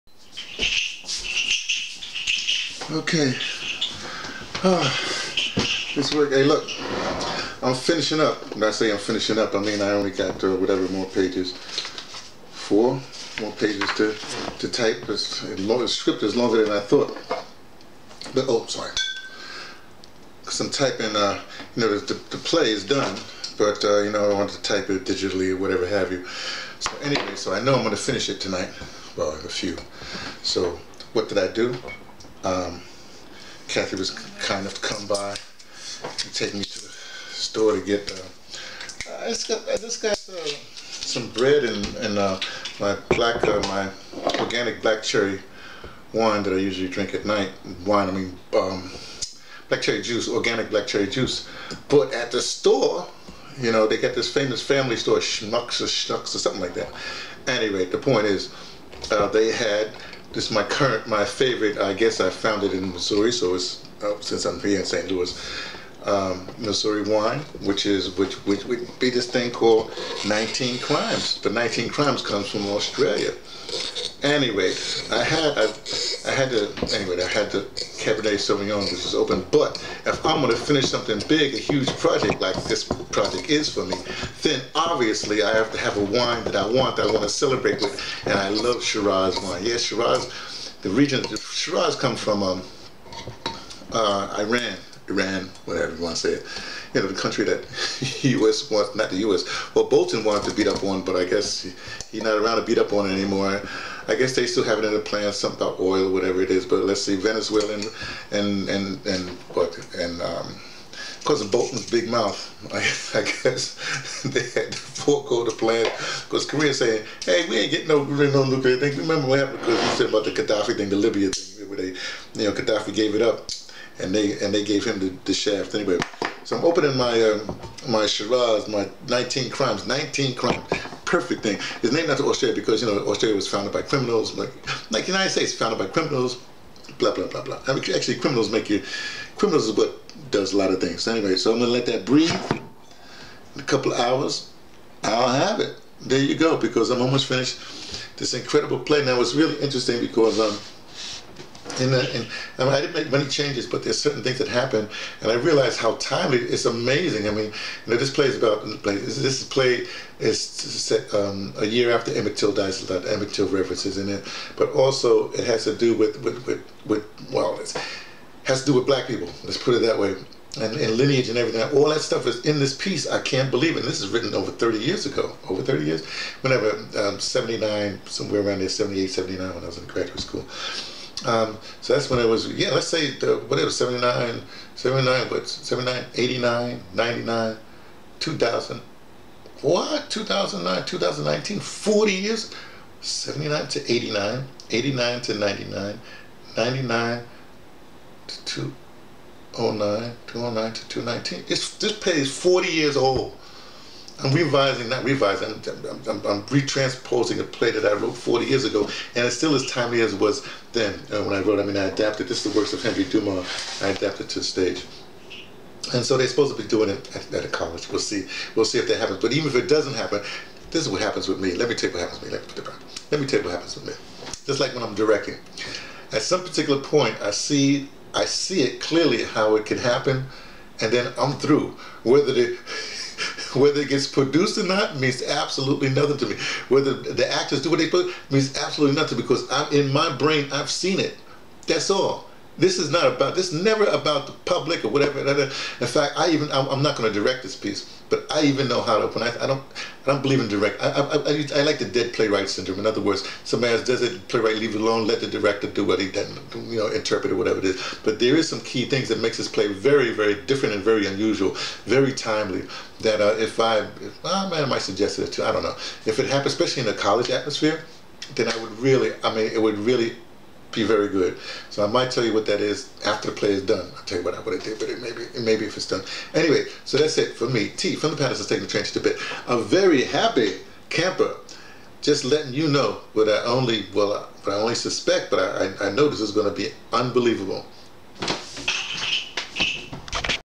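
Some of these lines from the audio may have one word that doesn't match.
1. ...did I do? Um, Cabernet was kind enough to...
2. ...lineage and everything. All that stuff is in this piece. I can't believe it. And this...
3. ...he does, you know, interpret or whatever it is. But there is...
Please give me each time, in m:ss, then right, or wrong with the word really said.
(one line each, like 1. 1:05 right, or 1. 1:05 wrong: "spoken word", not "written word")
1. 0:31 wrong: "Kathy", not "Cabernet"
2. 2:50 right
3. 4:15 right.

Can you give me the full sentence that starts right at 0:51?
But at the store, you know, they got this famous family store, Schmucks or Schnucks or something like that.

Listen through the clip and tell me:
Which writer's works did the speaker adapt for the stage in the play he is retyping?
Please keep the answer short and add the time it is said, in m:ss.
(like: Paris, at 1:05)
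Henry Dumas, at 3:32.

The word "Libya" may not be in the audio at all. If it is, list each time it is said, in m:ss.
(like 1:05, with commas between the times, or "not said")
2:00.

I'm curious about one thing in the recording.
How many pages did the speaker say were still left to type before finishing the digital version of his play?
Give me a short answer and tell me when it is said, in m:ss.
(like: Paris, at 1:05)
4, at 0:12.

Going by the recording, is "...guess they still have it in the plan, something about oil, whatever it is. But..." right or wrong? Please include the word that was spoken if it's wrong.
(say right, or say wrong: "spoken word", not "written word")
right.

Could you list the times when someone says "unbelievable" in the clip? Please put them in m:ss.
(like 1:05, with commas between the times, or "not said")
4:46.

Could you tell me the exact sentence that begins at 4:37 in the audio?
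T from the Patterson's taking the train to Tibet A very happy camper.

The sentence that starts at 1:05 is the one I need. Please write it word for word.
Louis, um, Missouri wine, which is which which would be this thing called 19 Crimes.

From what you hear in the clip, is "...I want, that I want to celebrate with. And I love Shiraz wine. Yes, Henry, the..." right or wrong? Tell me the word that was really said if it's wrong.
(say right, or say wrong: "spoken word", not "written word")
wrong: "Shiraz", not "Henry".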